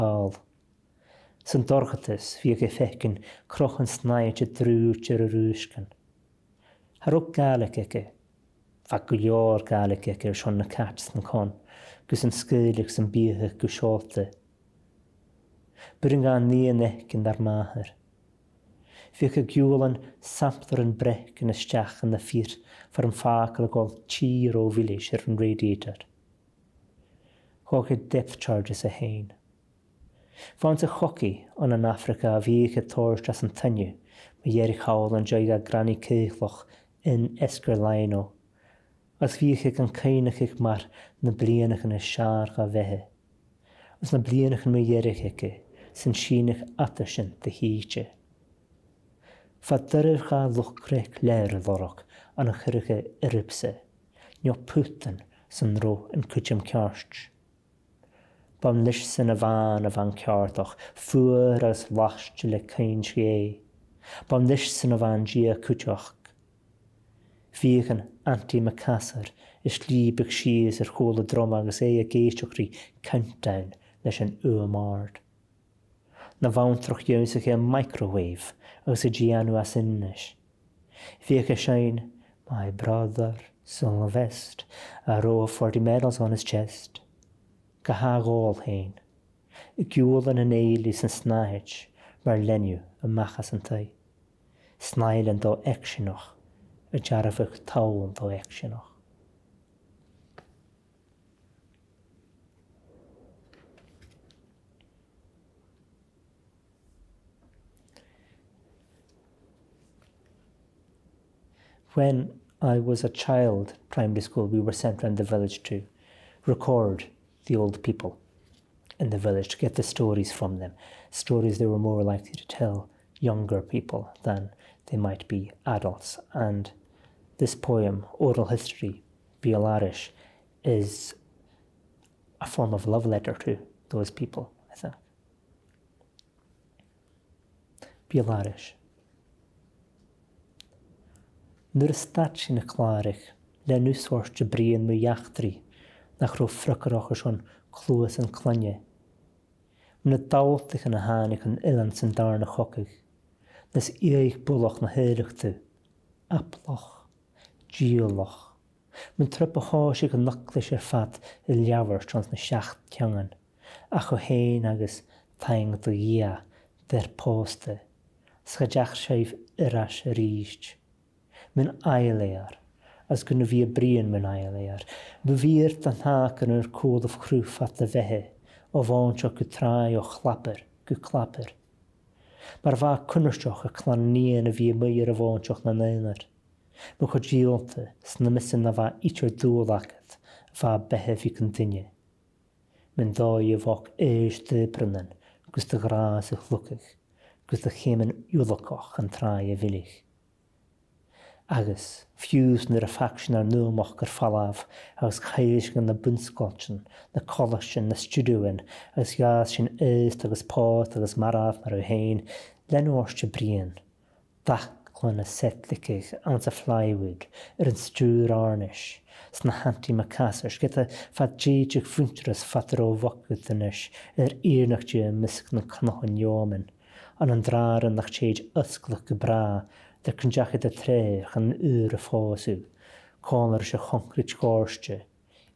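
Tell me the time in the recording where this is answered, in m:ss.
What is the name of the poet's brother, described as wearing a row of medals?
1:23.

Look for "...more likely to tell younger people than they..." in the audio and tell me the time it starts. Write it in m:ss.
2:01.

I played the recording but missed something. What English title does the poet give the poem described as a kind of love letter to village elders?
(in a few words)
Oral History.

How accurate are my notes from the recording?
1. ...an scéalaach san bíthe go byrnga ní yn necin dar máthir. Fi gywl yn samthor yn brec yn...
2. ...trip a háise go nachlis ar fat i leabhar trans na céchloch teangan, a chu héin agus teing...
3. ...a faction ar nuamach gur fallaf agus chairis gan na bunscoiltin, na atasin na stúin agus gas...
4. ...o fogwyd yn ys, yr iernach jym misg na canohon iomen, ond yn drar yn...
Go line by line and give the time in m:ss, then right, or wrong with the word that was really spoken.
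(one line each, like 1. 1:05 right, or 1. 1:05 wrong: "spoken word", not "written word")
1. 0:12 right
2. 2:39 wrong: "seaach", not "céchloch"
3. 3:22 wrong: "colasin", not "atasin"
4. 3:42 right.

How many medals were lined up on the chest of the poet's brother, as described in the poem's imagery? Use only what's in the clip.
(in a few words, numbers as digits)
40.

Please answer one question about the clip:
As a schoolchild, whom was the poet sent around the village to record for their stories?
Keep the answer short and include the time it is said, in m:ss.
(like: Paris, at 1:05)
the old people, at 1:57.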